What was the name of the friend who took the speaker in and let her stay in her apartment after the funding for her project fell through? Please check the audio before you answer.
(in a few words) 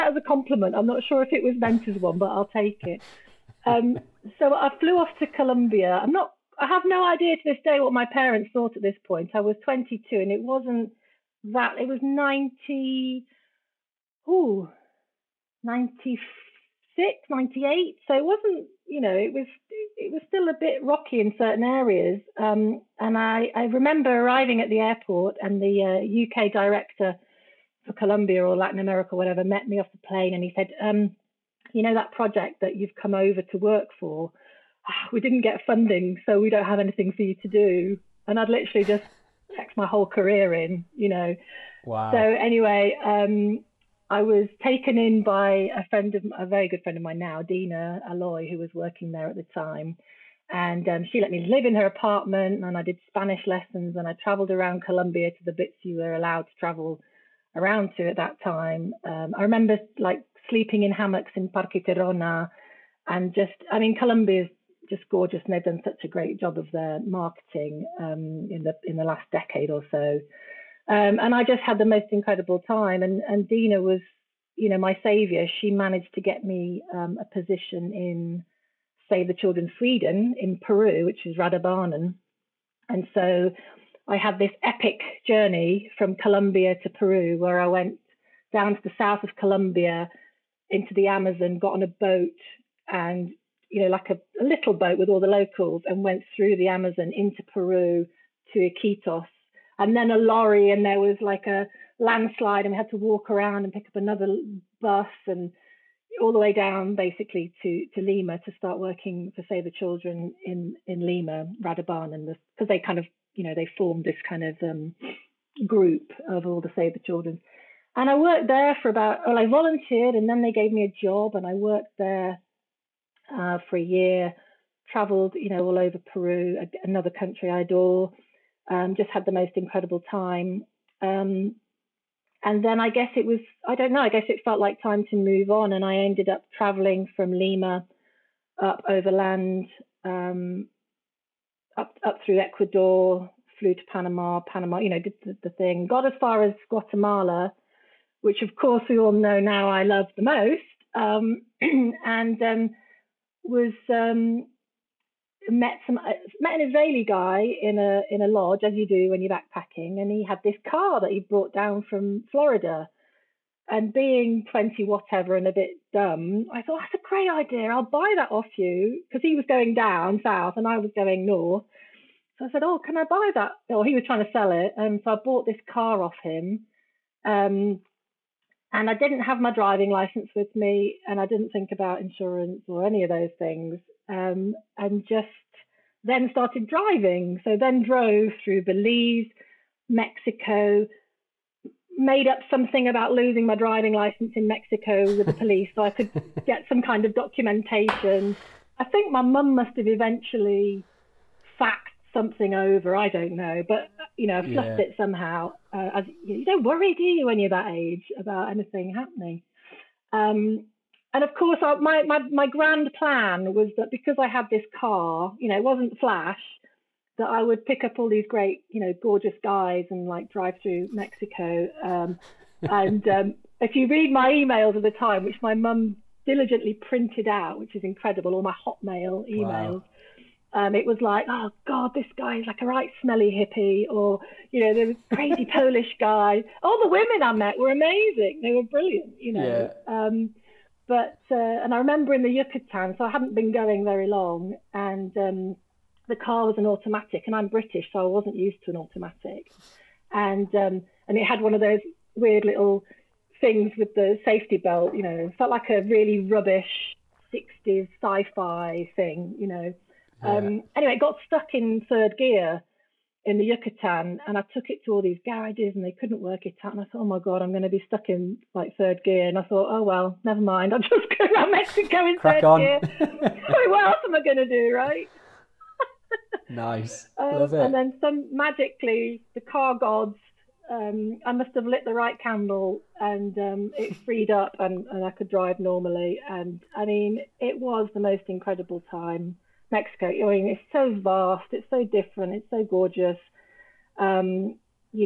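Dina Aloy.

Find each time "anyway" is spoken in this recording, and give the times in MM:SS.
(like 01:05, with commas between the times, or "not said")
00:42, 04:20.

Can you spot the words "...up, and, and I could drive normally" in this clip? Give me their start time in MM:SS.
04:44.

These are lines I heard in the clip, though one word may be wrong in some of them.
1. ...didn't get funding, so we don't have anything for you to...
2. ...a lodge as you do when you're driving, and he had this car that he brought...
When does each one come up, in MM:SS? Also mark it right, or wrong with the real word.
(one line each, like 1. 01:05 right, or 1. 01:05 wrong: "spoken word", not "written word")
1. 00:35 right
2. 02:38 wrong: "backpacking", not "driving".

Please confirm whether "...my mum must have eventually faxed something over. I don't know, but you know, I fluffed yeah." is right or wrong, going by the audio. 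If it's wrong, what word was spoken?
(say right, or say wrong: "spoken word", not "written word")
right.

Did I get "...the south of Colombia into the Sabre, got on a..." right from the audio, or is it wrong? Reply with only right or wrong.
wrong.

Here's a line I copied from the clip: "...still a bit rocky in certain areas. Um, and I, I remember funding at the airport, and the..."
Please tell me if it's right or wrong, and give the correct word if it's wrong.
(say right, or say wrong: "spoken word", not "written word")
wrong: "arriving", not "funding".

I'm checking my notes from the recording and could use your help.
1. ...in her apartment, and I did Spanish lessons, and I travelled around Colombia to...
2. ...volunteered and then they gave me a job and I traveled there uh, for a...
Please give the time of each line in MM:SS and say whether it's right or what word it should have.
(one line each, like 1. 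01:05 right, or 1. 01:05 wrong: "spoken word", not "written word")
1. 00:51 right
2. 01:59 wrong: "worked", not "traveled".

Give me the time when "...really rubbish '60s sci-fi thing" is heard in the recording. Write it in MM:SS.
04:15.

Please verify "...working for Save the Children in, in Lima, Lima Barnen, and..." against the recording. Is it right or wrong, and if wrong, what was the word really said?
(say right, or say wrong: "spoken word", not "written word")
wrong: "Rädda", not "Lima".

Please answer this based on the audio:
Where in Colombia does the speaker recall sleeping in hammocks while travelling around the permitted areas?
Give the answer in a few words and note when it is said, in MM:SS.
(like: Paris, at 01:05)
Parque Tayrona, at 01:01.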